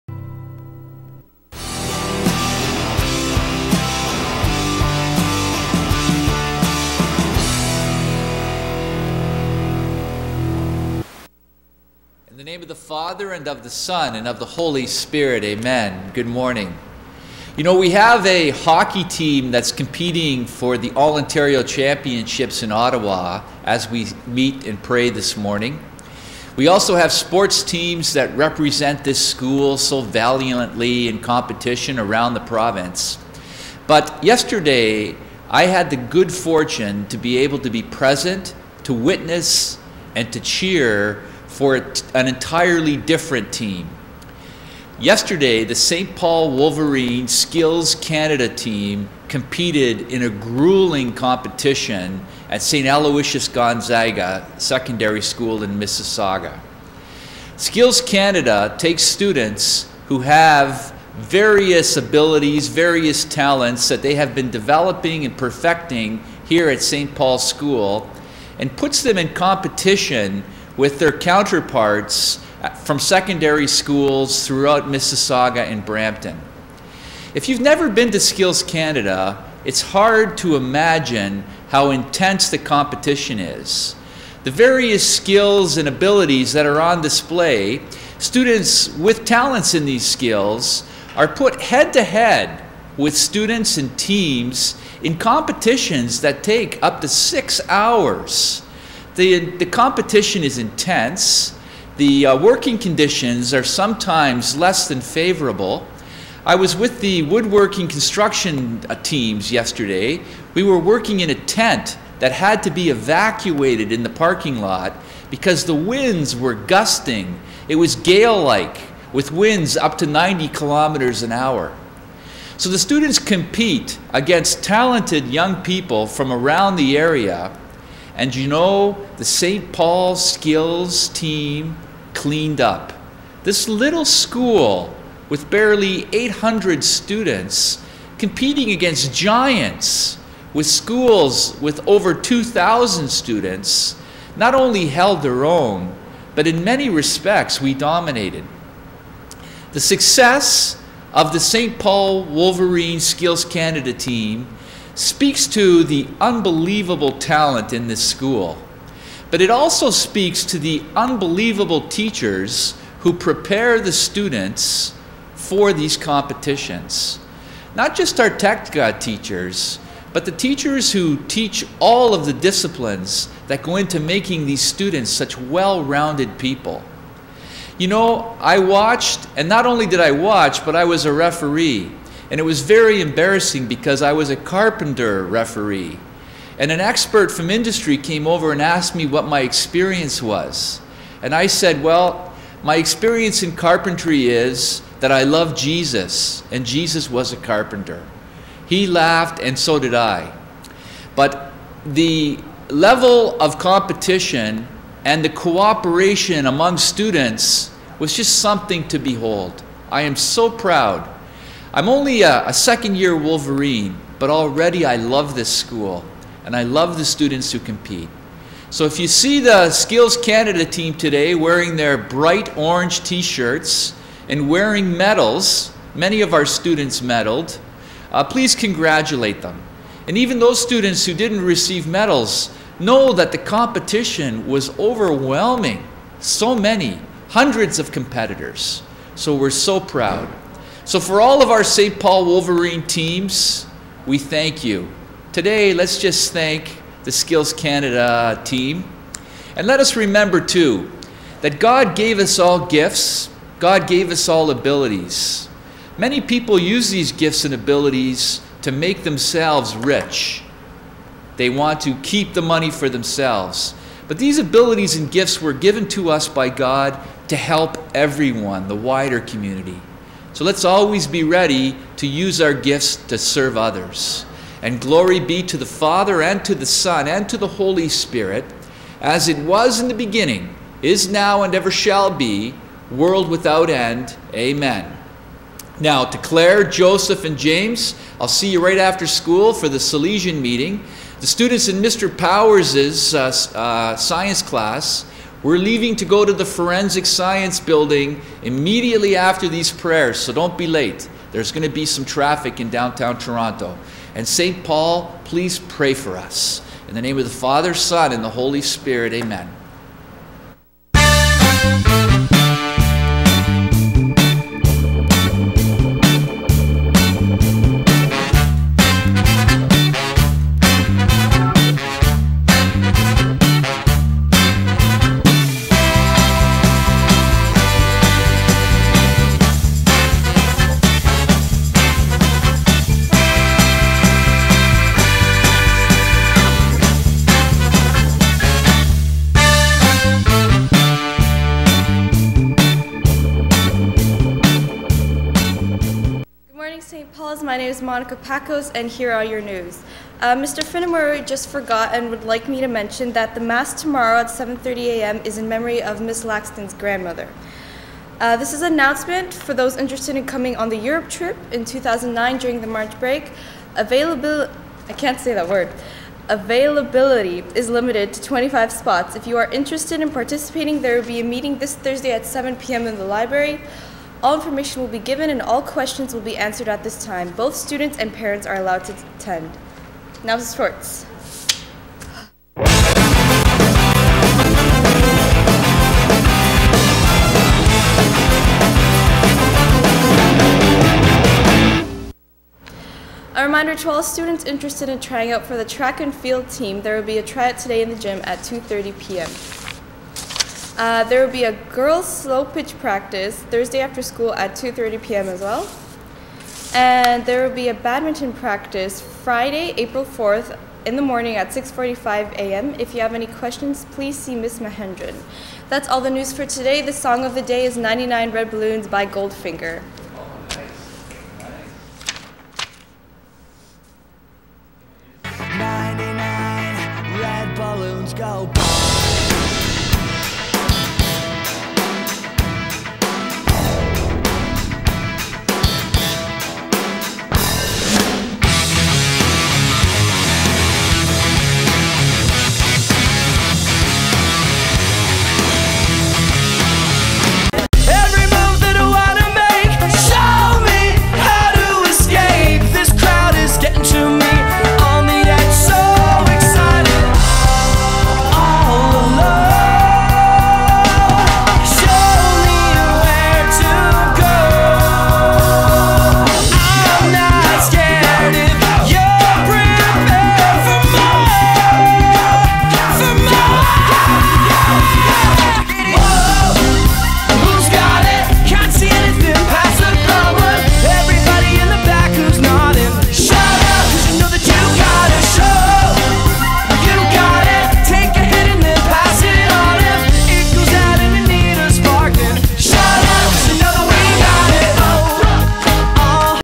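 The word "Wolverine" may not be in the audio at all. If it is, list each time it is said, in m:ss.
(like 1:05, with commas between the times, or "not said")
0:46, 2:32, 3:33, 4:02.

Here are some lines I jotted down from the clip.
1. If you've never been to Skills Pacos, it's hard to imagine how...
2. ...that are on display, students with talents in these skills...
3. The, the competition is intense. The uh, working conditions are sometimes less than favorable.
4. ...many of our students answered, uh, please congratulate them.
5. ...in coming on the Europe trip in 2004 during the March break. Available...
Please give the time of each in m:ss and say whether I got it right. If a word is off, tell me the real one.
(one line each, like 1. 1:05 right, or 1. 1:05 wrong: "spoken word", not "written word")
1. 1:17 wrong: "Canada", not "Pacos"
2. 1:26 right
3. 1:39 right
4. 3:45 wrong: "medaled", not "answered"
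5. 6:00 wrong: "2009", not "2004".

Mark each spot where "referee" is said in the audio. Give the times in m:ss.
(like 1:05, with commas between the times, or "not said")
3:01, 3:05.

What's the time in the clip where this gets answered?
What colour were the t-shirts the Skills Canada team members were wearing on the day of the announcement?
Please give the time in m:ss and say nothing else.
3:41.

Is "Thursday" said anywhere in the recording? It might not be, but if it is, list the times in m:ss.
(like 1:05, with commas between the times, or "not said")
6:11, 6:43.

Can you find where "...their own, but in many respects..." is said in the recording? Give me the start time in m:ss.
2:25.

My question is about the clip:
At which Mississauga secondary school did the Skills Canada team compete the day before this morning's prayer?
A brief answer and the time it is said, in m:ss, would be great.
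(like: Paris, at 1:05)
St. Aloysius Gonzaga, at 0:52.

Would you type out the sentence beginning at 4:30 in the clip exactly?
So let's always be ready to use our gifts to serve others.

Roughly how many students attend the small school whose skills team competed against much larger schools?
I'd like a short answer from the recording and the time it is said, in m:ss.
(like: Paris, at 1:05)
800, at 2:16.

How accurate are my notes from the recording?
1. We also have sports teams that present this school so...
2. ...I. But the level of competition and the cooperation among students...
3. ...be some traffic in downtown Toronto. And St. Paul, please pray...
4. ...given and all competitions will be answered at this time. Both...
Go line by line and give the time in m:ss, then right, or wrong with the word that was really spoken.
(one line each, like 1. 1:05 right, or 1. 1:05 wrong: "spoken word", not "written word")
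1. 0:26 wrong: "represent", not "present"
2. 3:19 right
3. 5:01 right
4. 6:14 wrong: "questions", not "competitions".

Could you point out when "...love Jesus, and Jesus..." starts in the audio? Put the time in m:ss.
3:15.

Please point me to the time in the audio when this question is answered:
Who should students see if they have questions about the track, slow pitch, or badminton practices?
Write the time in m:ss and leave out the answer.
6:54.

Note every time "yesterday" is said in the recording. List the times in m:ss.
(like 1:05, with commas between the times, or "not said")
0:34, 0:44, 1:49.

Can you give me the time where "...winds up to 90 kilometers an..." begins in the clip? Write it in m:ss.
1:59.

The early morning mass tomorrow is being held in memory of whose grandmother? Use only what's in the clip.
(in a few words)
Miss Laxton.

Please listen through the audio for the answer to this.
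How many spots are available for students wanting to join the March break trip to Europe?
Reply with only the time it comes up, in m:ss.
6:08.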